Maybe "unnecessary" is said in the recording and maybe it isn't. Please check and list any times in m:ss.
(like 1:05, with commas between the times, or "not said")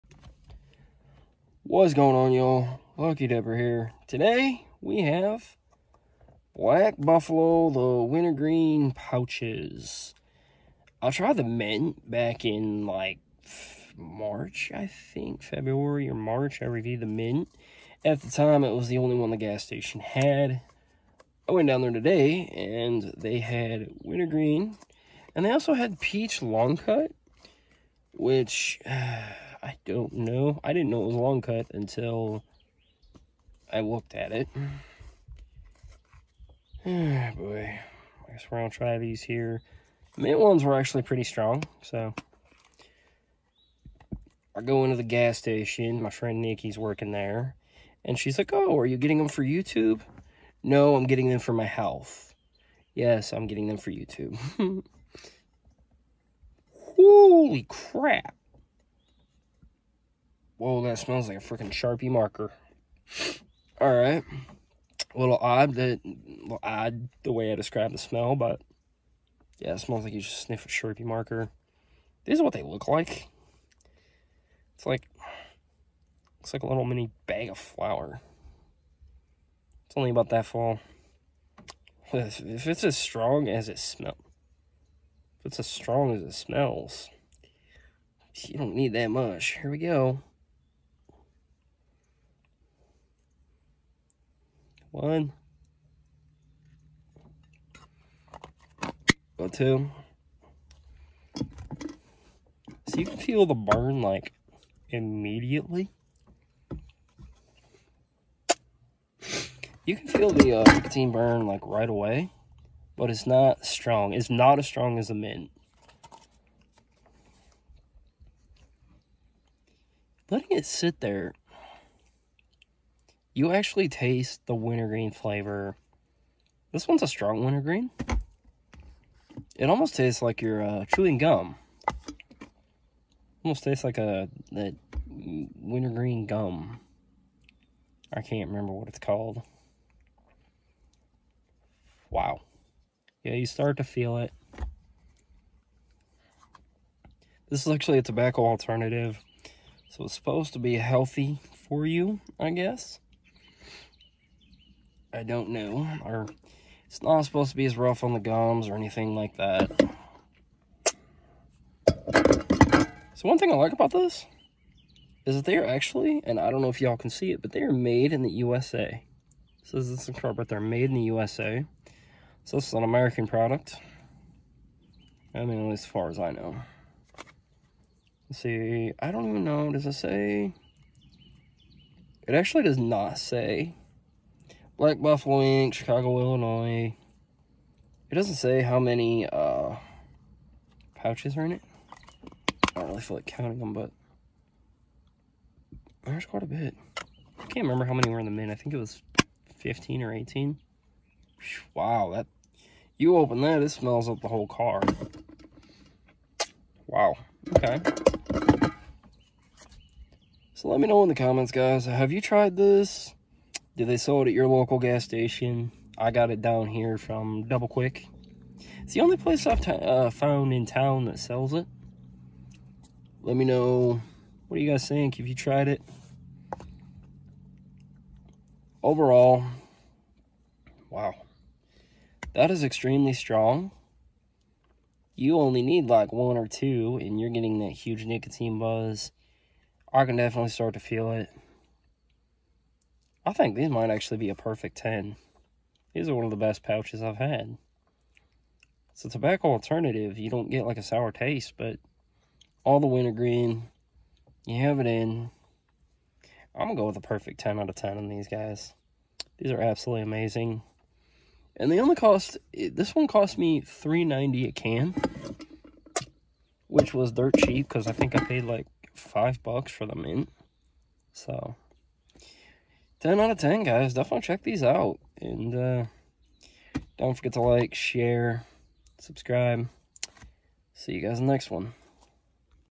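not said.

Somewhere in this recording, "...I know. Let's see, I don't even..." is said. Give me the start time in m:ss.
2:56.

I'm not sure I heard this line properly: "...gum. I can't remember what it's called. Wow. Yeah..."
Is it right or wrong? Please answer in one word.
right.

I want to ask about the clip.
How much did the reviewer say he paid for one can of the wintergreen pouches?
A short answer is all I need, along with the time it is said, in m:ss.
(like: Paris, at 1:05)
$3.90, at 4:23.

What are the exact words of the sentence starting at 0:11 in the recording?
I tried the mint back in, like, March, I think, February or March.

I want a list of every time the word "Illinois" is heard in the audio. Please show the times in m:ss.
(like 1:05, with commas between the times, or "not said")
3:06.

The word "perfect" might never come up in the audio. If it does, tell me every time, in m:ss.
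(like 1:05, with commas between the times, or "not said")
4:04, 4:17.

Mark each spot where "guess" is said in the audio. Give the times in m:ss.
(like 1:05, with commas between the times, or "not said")
0:38, 2:32.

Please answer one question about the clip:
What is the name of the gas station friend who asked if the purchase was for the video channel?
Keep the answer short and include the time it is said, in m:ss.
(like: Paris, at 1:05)
Nikki, at 0:46.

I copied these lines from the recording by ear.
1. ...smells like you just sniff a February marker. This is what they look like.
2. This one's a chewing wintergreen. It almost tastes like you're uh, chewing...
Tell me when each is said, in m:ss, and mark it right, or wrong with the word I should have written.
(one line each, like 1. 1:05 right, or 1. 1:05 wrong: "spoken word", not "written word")
1. 1:09 wrong: "Sharpie", not "February"
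2. 2:06 wrong: "strong", not "chewing".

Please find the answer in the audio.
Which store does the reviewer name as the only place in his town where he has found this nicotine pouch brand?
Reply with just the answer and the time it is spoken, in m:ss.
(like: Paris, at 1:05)
Double Quick, at 3:37.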